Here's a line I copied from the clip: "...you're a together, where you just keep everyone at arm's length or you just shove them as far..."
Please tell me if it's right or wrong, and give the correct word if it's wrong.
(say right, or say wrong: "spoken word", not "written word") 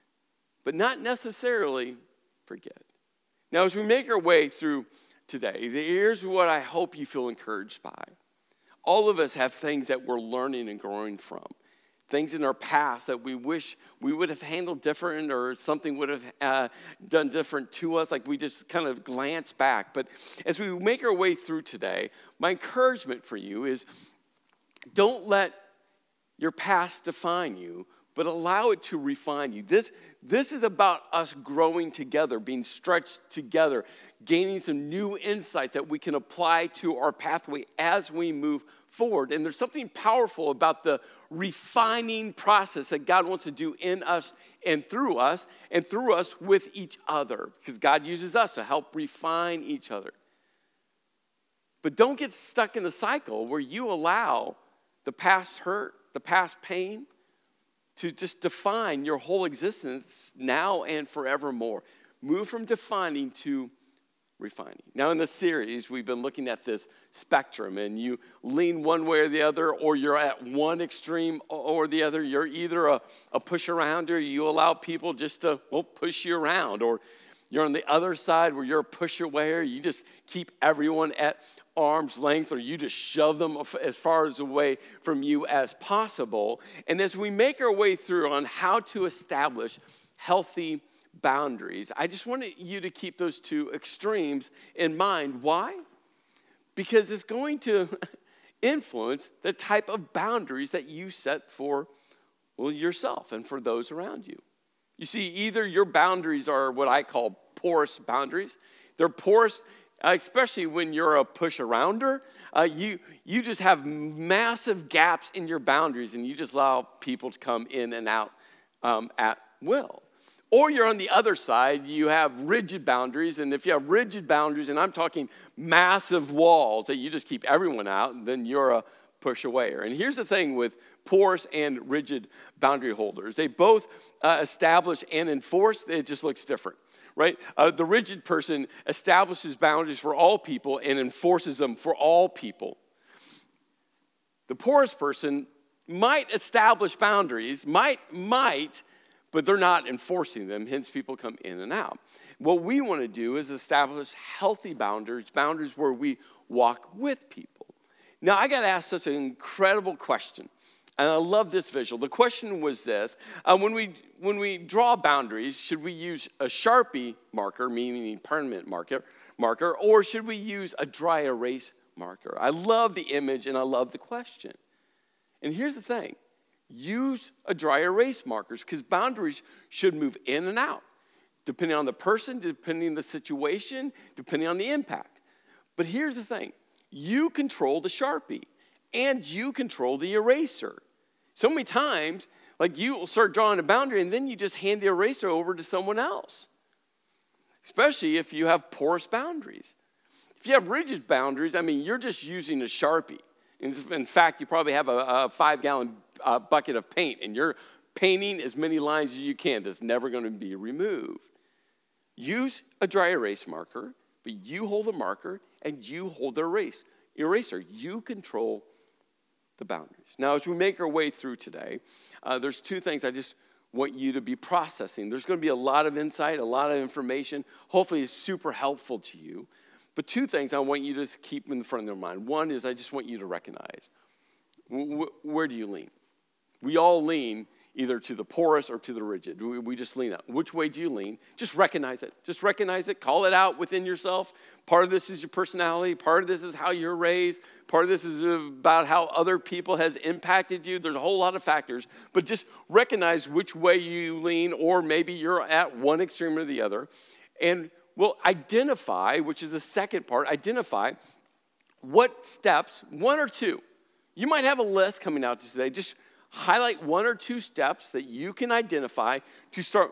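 wrong: "pusher", not "together".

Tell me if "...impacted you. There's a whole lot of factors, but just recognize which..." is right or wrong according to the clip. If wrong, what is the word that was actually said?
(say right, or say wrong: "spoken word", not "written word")
right.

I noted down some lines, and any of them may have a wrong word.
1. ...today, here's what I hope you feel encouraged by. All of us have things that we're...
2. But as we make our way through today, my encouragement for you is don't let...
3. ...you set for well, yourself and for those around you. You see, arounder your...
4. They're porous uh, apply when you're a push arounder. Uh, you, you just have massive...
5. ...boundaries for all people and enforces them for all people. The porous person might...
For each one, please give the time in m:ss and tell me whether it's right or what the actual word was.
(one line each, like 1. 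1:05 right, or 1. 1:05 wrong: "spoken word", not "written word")
1. 0:05 right
2. 0:19 right
3. 1:40 wrong: "either", not "arounder"
4. 1:48 wrong: "especially", not "apply"
5. 2:19 right.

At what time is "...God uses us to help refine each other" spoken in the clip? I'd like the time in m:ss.
0:47.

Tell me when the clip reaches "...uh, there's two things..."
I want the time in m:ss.
3:42.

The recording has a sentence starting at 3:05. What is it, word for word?
But here's the thing you control the Sharpie and you control the eraser.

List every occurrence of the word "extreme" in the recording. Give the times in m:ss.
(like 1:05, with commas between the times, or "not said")
1:10, 1:33, 4:16.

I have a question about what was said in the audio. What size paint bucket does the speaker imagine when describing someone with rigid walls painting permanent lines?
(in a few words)
5 gallon.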